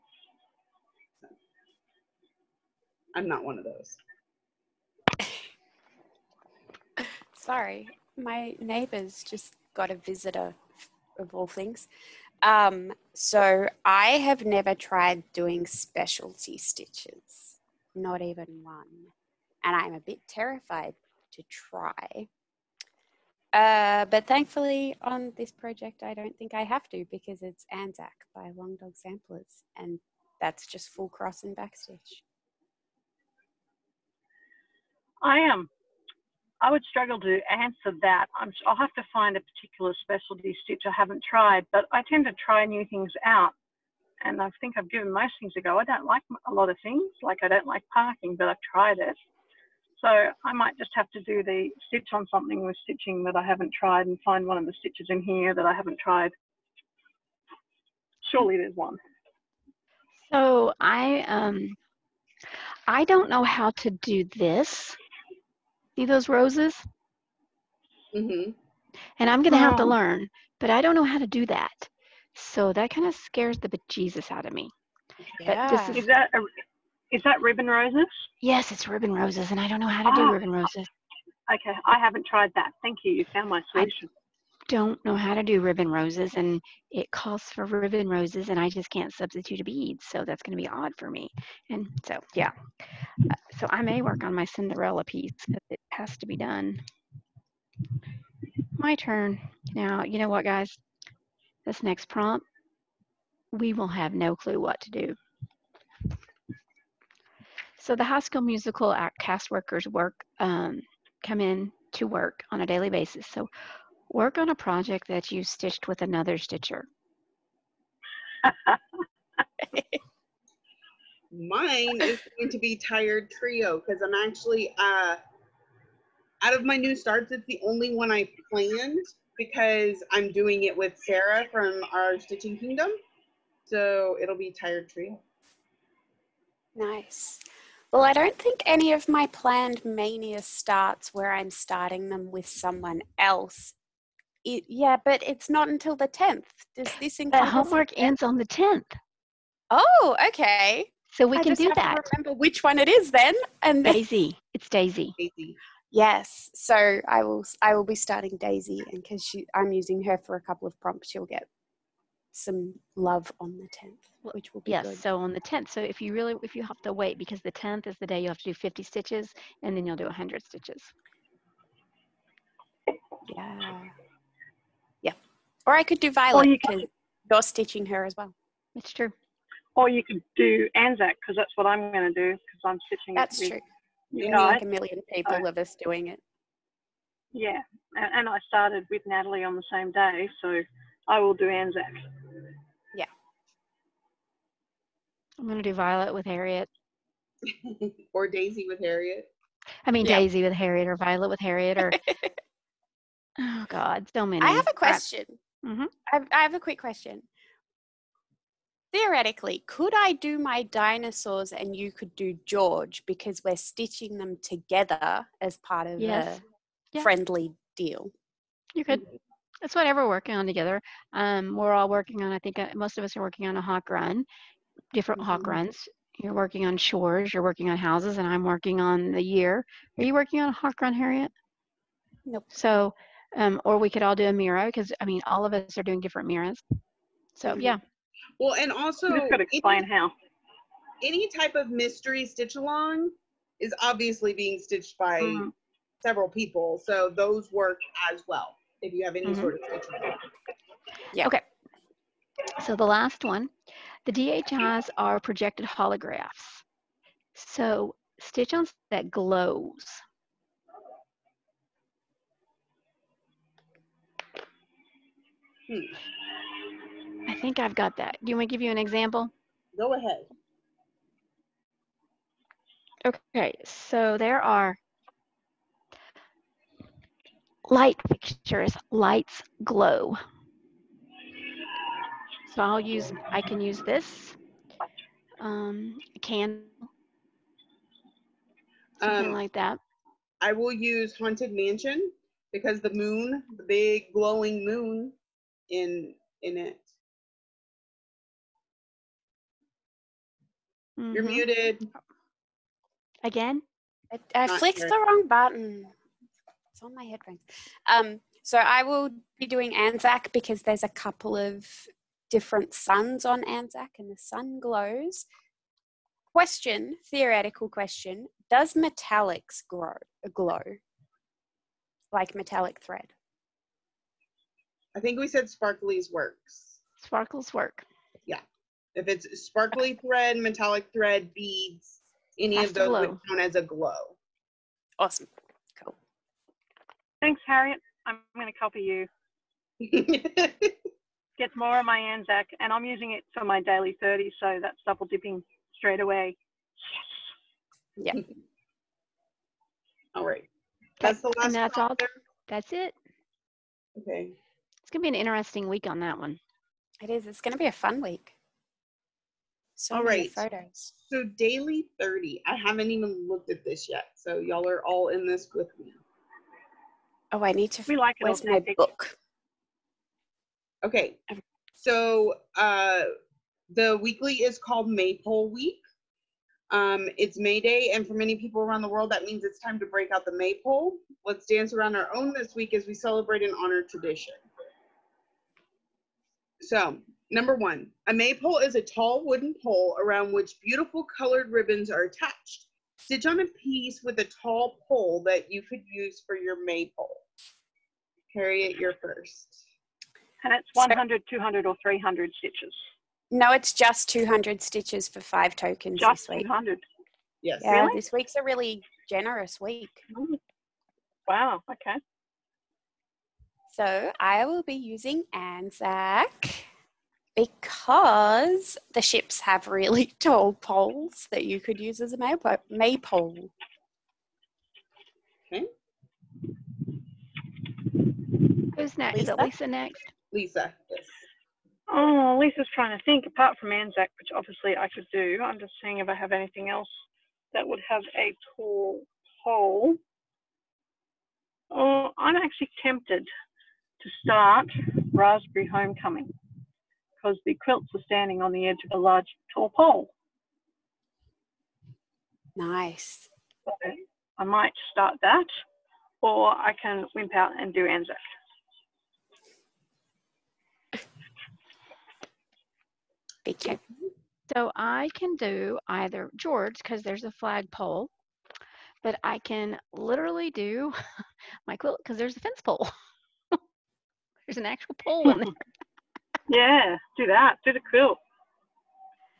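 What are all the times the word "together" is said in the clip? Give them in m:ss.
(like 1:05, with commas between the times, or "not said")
3:34, 3:40.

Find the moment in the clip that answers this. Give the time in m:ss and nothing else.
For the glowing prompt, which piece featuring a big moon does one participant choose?
4:51.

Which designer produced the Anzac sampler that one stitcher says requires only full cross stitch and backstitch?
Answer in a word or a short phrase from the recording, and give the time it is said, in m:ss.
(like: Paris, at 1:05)
Long Dog Samplers, at 0:28.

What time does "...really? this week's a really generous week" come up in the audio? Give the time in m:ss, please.
6:47.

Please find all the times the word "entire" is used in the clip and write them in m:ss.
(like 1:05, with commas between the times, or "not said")
not said.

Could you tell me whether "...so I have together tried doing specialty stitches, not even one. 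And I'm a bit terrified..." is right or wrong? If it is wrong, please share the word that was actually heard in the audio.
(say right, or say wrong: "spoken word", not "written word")
wrong: "never", not "together".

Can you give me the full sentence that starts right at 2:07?
It's the only one I planned because I'm doing it with Sarah from our Stitching Kingdom.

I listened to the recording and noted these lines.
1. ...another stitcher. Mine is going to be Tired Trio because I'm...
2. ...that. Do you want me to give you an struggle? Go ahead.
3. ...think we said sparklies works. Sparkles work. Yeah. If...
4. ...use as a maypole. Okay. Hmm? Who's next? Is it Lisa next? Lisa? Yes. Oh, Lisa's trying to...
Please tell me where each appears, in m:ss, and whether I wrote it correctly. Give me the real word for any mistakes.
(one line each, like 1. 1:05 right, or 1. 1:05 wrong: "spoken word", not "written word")
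1. 1:56 right
2. 4:27 wrong: "example", not "struggle"
3. 5:24 right
4. 7:01 right.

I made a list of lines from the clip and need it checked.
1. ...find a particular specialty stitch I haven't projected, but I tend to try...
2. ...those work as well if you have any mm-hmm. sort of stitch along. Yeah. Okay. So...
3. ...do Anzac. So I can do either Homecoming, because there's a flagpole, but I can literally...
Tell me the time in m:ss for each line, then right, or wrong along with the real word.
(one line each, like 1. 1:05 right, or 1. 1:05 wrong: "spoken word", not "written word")
1. 0:39 wrong: "tried", not "projected"
2. 4:07 right
3. 7:37 wrong: "George", not "Homecoming".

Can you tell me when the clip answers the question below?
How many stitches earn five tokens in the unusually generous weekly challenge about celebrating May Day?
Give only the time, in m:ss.
6:44.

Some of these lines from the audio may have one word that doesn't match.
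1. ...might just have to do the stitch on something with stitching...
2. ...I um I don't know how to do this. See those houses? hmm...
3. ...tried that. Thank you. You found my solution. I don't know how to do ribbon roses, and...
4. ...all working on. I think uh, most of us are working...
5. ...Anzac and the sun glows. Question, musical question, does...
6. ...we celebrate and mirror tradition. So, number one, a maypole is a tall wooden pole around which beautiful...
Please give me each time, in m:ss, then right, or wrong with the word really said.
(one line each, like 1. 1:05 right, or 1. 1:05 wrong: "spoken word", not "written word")
1. 0:50 right
2. 1:00 wrong: "roses", not "houses"
3. 1:22 right
4. 3:41 right
5. 5:13 wrong: "theoretical", not "musical"
6. 6:22 wrong: "honor", not "mirror".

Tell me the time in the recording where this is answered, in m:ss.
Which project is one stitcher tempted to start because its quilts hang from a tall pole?
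7:25.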